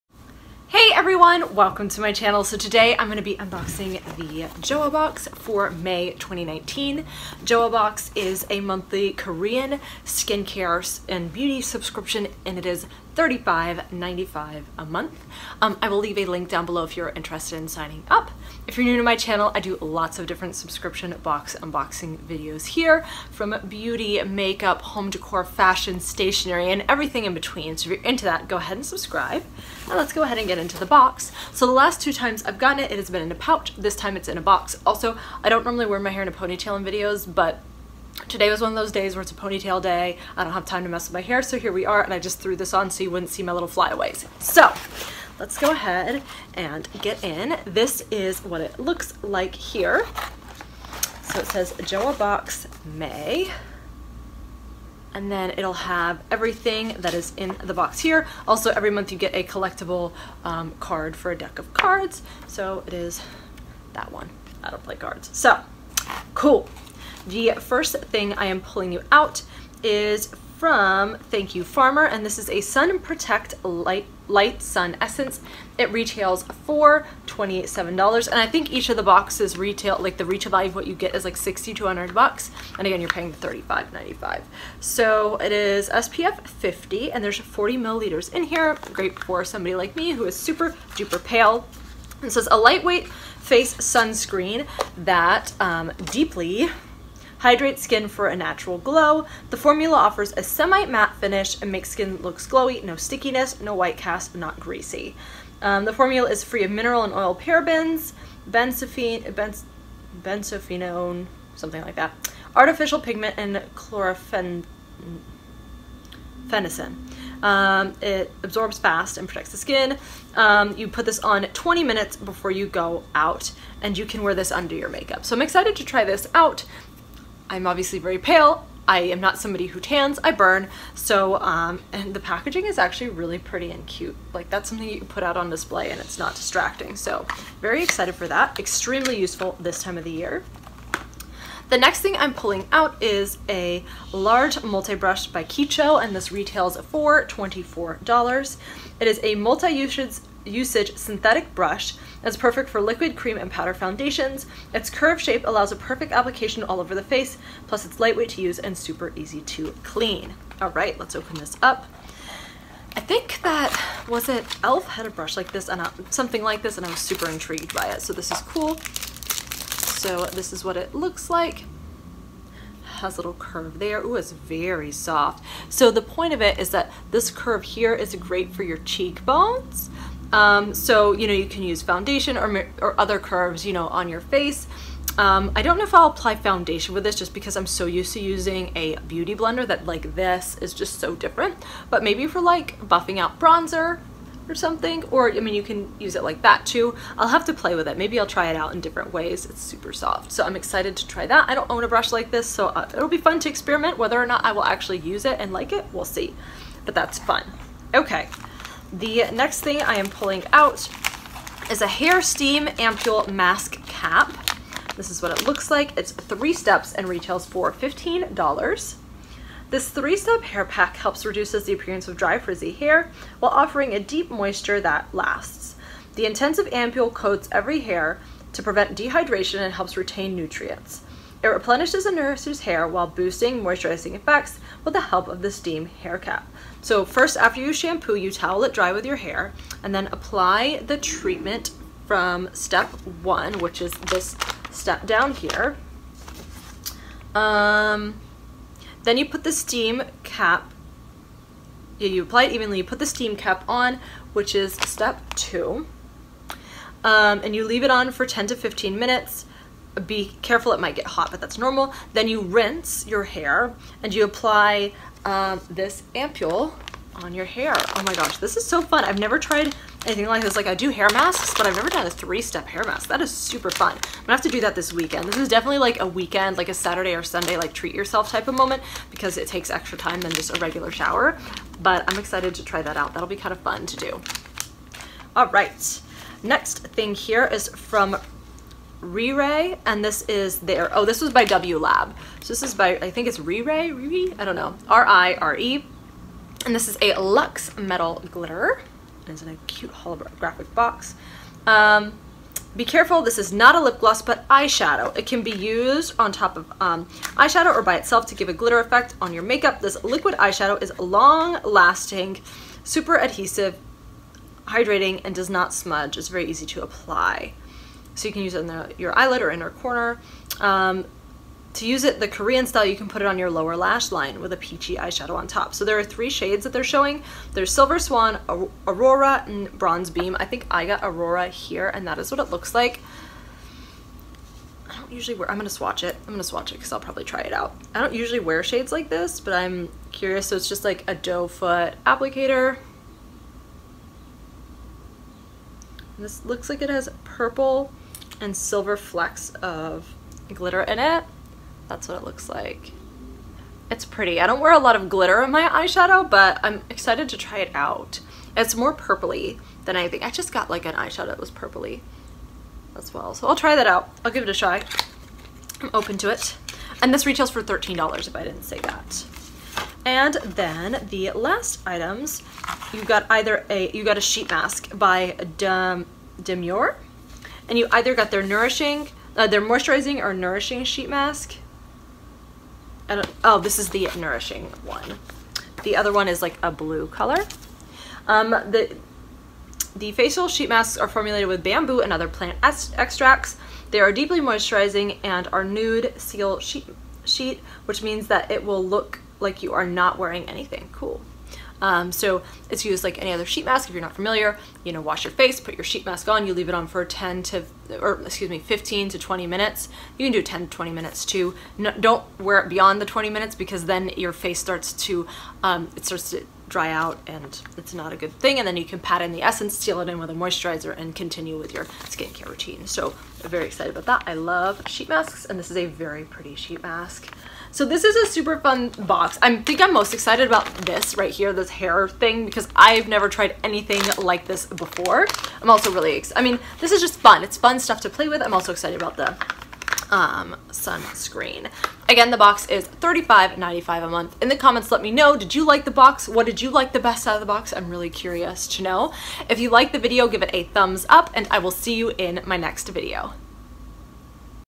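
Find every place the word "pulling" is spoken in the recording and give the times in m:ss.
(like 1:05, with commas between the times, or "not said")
1:08, 2:22, 3:30.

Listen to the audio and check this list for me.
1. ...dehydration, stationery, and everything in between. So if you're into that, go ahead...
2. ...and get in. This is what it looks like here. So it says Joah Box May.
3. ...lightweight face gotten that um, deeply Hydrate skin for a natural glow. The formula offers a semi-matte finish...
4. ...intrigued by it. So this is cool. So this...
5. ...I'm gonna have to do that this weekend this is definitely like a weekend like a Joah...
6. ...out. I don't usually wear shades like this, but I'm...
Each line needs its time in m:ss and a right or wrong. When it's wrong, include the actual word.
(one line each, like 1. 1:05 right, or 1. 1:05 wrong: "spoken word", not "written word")
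1. 0:25 wrong: "fashion", not "dehydration"
2. 0:46 right
3. 1:32 wrong: "sunscreen", not "gotten"
4. 2:47 right
5. 4:33 wrong: "Saturday", not "Joah"
6. 5:37 right.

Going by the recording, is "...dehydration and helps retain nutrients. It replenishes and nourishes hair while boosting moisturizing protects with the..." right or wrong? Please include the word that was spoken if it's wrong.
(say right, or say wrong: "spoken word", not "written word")
wrong: "effects", not "protects".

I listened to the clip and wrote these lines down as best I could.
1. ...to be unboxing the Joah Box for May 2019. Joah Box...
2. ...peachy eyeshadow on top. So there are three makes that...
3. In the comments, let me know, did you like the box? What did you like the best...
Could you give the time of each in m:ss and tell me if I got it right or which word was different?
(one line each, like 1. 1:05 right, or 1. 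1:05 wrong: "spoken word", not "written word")
1. 0:03 right
2. 5:24 wrong: "shades", not "makes"
3. 7:24 right.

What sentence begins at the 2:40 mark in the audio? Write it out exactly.
All right, let's open this up.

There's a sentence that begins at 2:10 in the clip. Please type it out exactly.
So, um, and the packaging is actually really pretty and cute.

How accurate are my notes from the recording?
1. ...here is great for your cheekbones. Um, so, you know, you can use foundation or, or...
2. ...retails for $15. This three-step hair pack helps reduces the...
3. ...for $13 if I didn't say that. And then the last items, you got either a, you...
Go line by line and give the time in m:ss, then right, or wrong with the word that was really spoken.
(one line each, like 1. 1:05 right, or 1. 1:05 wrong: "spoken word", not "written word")
1. 2:57 right
2. 3:37 right
3. 6:07 right.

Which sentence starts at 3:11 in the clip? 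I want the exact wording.
But maybe for like buffing out bronzer or something, or I mean, you can use it like that too.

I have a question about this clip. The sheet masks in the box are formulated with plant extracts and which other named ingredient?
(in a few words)
bamboo.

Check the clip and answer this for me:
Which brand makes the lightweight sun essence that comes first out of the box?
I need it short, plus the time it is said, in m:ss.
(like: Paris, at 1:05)
Thank You Farmer, at 1:11.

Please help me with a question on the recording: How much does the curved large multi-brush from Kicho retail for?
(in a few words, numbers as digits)
$24.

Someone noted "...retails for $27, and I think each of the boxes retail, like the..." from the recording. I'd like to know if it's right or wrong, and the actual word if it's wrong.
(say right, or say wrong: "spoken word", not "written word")
right.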